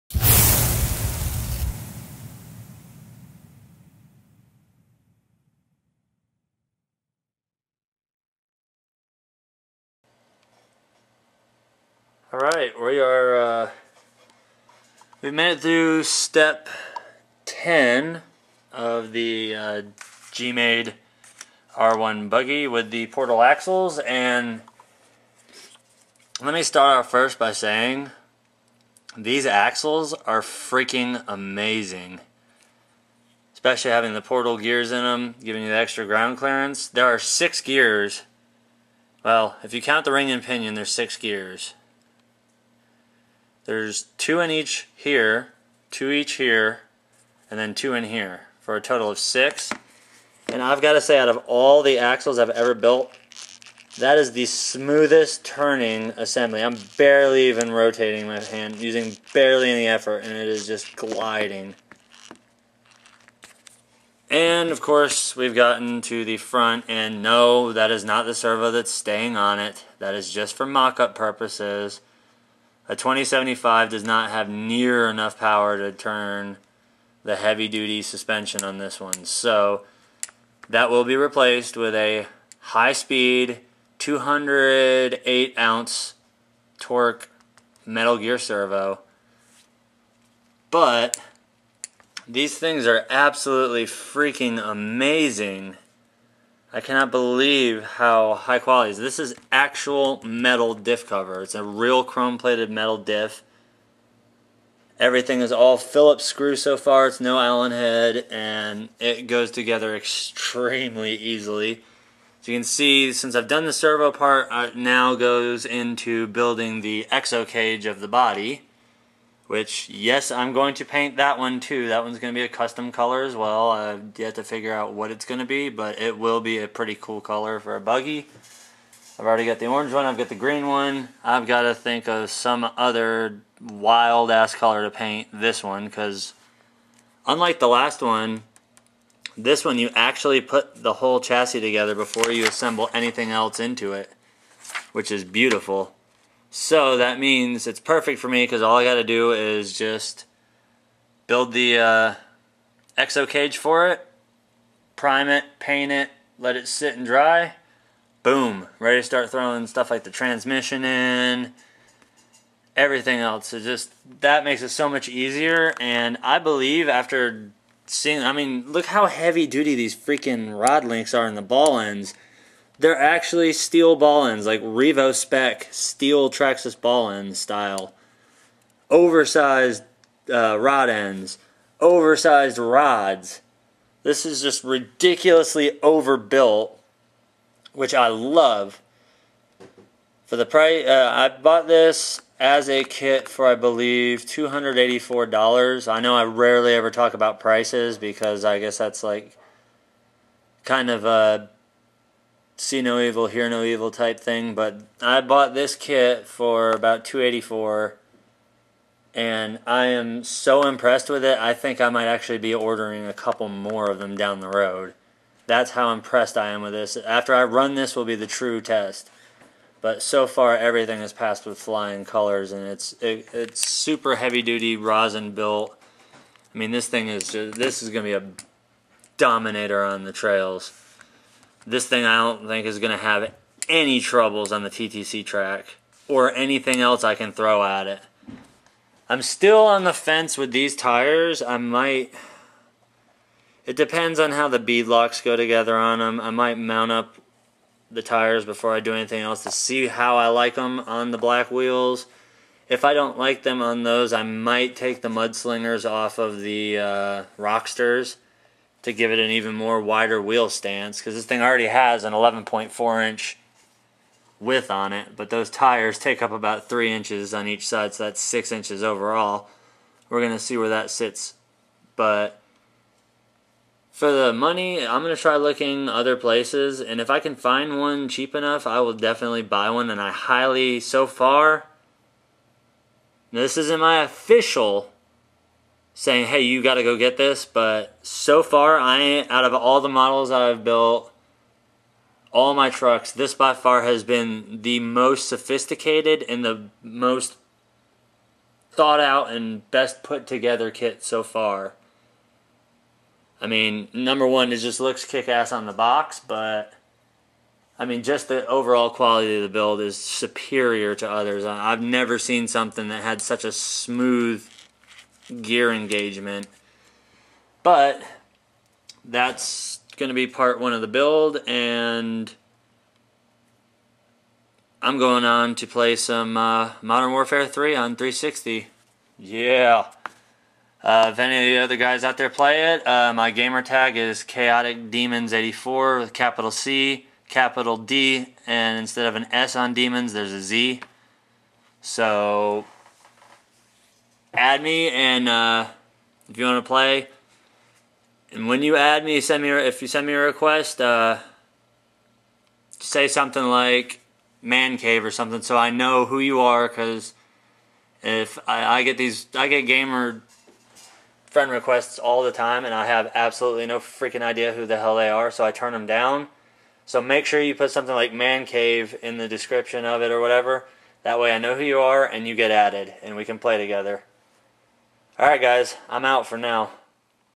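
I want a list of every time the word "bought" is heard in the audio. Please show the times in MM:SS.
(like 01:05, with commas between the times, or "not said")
03:11, 03:25.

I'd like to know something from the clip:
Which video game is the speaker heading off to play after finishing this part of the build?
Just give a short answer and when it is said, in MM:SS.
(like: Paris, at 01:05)
Modern Warfare 3, at 05:26.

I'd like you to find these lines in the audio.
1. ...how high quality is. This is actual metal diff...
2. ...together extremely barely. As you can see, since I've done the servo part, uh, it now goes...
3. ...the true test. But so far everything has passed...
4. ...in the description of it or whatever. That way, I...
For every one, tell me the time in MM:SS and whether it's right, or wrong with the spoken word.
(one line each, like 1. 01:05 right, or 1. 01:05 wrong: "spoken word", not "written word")
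1. 01:37 right
2. 01:49 wrong: "easily", not "barely"
3. 03:38 right
4. 06:09 right.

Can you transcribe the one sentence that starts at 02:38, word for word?
Boom, ready to start throwing stuff like the transmission in, everything else.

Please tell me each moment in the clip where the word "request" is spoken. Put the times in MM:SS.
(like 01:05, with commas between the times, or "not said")
05:50, 06:01.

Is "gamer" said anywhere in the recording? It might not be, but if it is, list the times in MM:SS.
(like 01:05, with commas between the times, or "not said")
05:33, 05:59.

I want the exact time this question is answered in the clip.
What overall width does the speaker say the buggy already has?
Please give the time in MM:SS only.
04:22.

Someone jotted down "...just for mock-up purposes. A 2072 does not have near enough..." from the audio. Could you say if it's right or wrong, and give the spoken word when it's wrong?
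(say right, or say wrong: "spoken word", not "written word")
wrong: "2075", not "2072".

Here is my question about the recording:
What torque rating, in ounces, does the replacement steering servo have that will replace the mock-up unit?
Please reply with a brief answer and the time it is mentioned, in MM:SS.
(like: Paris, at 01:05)
208, at 01:23.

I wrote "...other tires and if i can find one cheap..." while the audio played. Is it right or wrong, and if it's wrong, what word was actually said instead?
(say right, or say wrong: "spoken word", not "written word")
wrong: "places", not "tires".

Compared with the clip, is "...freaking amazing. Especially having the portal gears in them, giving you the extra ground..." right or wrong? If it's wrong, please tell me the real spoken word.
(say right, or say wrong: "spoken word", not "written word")
right.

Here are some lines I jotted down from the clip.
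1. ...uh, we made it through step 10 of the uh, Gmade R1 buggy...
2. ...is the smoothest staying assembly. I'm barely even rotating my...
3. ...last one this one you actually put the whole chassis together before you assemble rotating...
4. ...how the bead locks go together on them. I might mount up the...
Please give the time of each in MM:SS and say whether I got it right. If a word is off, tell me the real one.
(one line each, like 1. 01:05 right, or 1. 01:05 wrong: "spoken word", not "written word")
1. 00:13 right
2. 00:54 wrong: "turning", not "staying"
3. 02:17 wrong: "anything", not "rotating"
4. 04:04 right.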